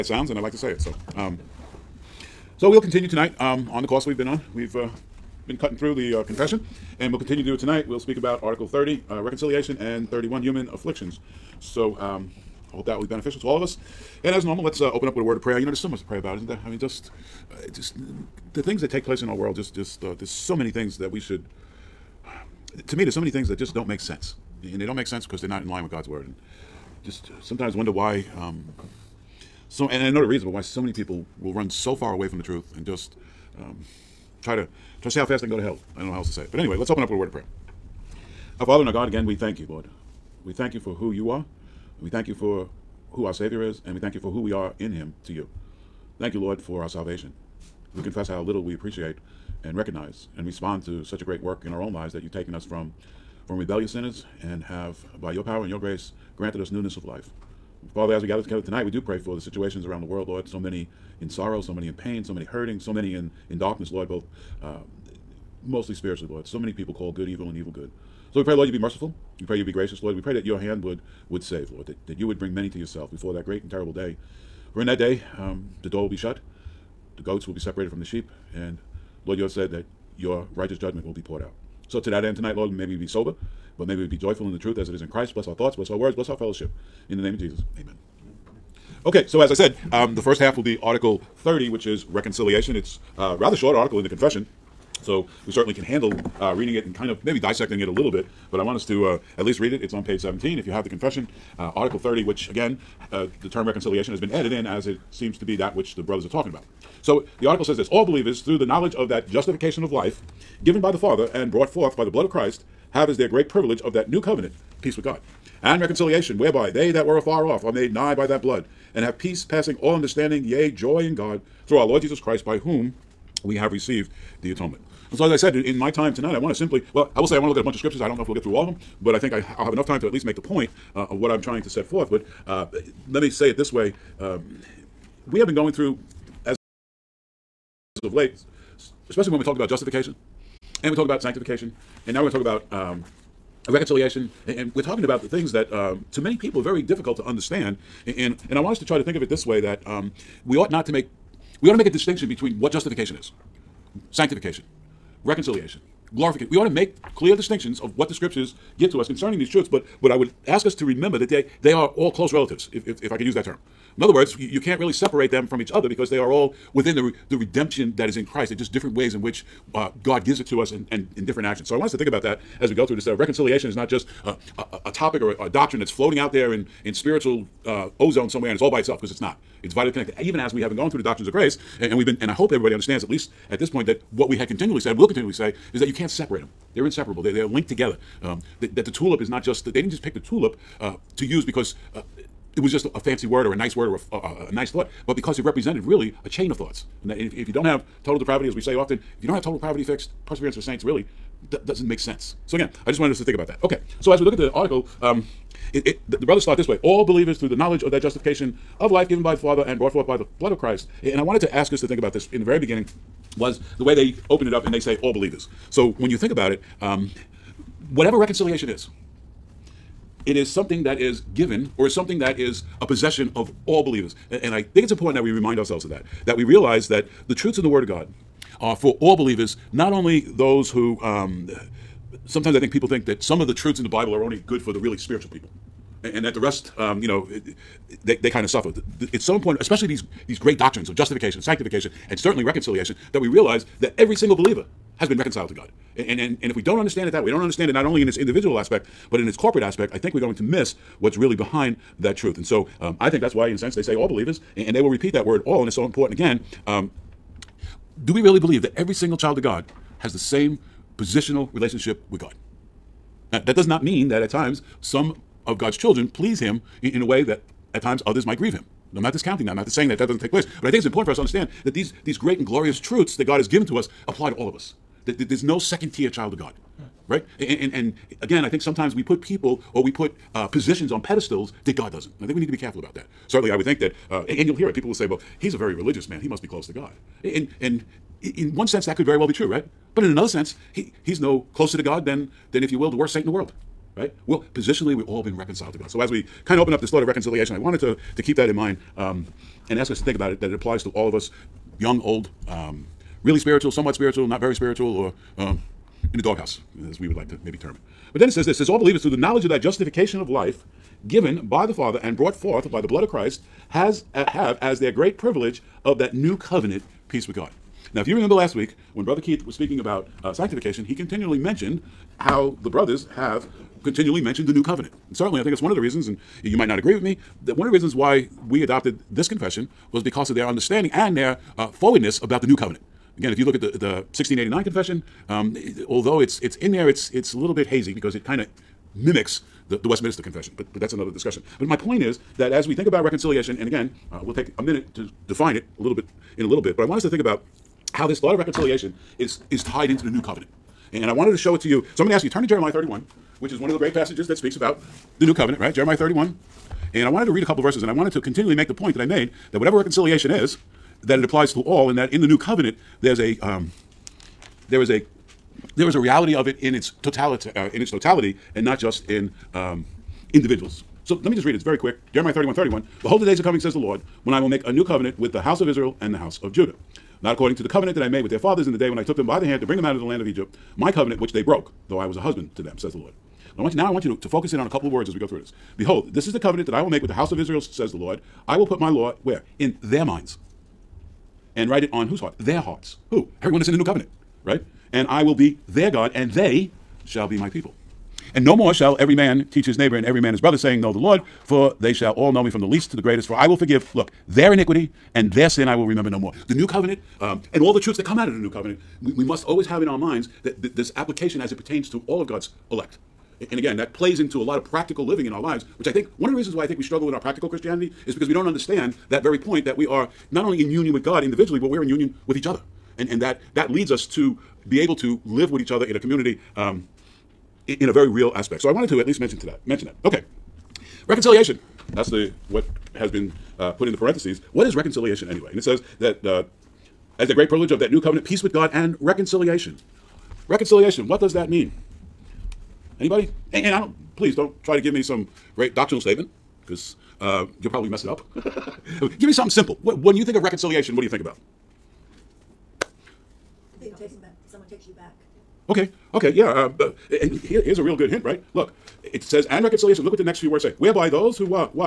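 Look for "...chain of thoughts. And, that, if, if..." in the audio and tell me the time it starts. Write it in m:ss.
3:16.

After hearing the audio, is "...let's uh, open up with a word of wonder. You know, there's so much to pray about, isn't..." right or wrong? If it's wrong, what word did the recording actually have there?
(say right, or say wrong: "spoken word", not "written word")
wrong: "prayer", not "wonder".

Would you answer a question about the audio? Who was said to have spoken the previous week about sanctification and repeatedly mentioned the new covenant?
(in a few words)
Brother Keith.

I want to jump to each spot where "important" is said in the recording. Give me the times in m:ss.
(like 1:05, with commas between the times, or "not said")
3:44, 3:59, 4:15, 4:30.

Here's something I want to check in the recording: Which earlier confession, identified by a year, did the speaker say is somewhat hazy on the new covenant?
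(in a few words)
1689 confession.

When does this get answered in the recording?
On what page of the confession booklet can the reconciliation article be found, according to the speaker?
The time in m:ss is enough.
1:40.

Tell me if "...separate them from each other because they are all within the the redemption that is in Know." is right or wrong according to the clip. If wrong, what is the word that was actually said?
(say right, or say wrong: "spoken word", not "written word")
wrong: "Christ", not "Know".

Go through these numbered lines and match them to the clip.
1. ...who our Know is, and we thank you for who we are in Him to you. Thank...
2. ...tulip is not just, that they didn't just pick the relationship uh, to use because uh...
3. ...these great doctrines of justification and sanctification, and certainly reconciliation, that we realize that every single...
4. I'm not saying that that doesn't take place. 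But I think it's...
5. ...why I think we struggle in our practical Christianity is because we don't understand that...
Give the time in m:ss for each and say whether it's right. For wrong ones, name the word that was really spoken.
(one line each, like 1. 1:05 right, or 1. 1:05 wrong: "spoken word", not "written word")
1. 0:43 wrong: "Savior", not "Know"
2. 3:08 wrong: "tulip", not "relationship"
3. 4:00 right
4. 4:29 right
5. 6:56 right.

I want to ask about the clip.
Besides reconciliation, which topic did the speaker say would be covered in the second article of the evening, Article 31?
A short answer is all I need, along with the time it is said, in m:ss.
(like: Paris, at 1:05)
Human afflictions, at 0:10.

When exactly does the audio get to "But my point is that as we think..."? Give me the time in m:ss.
5:41.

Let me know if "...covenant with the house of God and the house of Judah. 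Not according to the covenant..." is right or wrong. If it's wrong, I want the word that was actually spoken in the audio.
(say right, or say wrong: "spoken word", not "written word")
wrong: "Israel", not "God".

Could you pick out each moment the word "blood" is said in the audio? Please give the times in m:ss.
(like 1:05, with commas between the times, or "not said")
1:52, 1:58, 3:30, 5:12.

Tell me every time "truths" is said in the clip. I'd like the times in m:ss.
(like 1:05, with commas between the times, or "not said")
0:32, 1:24, 2:39, 3:47, 3:53, 4:12, 4:32, 6:47.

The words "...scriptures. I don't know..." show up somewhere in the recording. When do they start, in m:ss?
2:07.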